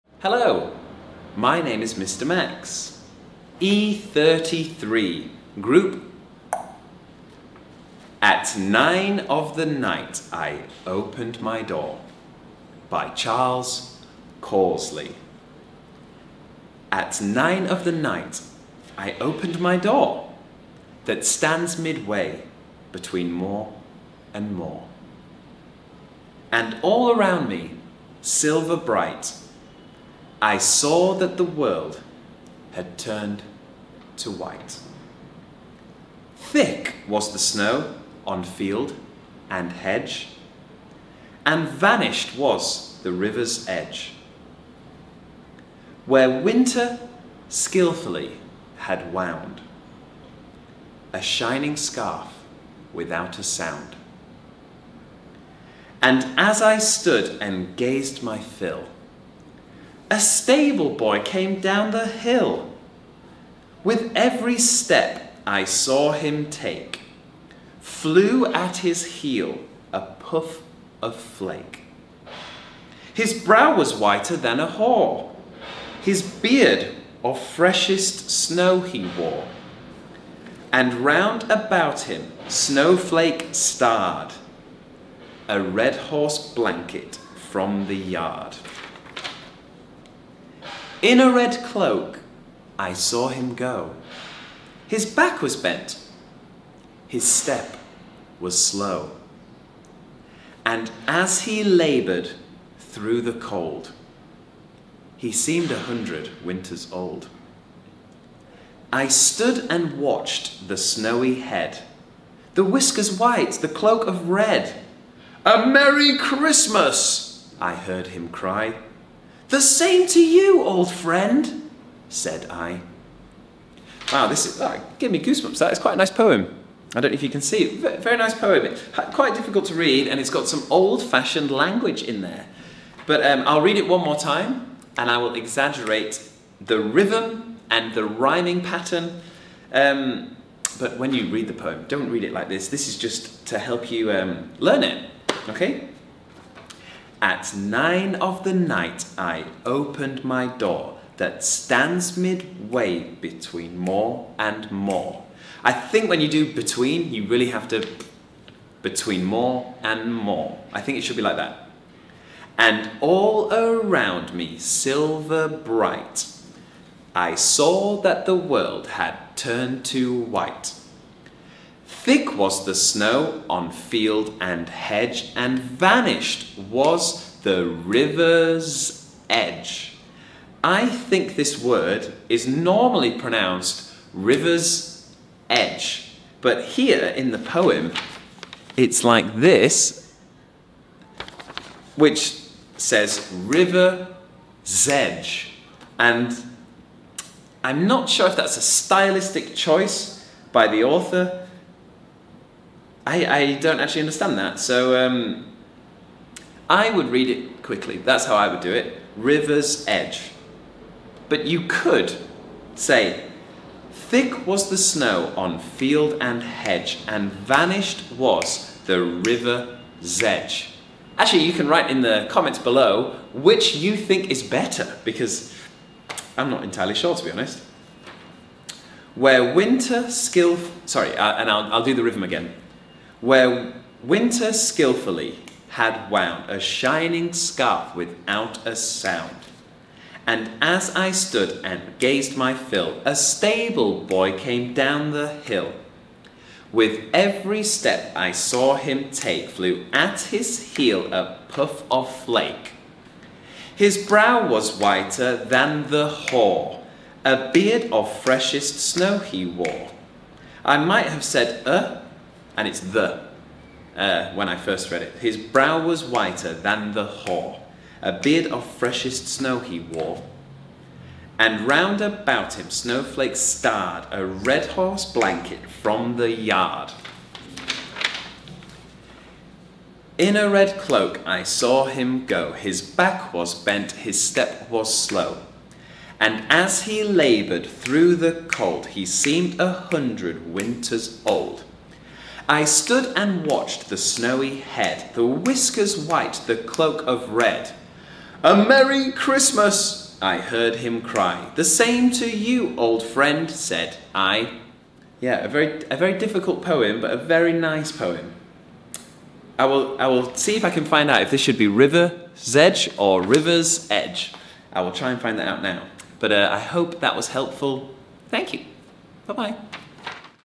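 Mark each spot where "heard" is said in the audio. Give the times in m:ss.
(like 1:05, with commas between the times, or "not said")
1:57, 5:00.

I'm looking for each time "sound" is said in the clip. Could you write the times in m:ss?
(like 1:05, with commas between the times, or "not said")
0:53, 3:58.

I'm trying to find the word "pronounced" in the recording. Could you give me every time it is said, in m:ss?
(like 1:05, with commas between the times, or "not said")
3:03.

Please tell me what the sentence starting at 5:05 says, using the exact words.
Yeah, a very, a very difficult poem, but a very nice poem.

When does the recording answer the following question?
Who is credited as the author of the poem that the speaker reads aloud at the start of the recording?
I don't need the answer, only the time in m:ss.
0:13.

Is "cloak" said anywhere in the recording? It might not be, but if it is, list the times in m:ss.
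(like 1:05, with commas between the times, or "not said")
1:31, 1:53, 4:40, 4:56.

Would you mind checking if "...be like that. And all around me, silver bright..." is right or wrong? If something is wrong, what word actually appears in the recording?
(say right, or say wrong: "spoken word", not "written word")
right.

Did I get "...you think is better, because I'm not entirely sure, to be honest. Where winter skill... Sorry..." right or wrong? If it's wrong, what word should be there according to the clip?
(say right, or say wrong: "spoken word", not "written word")
right.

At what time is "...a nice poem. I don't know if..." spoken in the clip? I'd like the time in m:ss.
2:05.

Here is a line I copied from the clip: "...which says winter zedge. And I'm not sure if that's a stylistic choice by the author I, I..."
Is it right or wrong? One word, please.
wrong.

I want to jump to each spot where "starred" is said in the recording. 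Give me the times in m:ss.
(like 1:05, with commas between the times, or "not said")
1:23, 4:33.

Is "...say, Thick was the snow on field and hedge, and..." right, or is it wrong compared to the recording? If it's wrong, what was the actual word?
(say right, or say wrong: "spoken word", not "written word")
right.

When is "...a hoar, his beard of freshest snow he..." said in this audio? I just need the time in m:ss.
1:14.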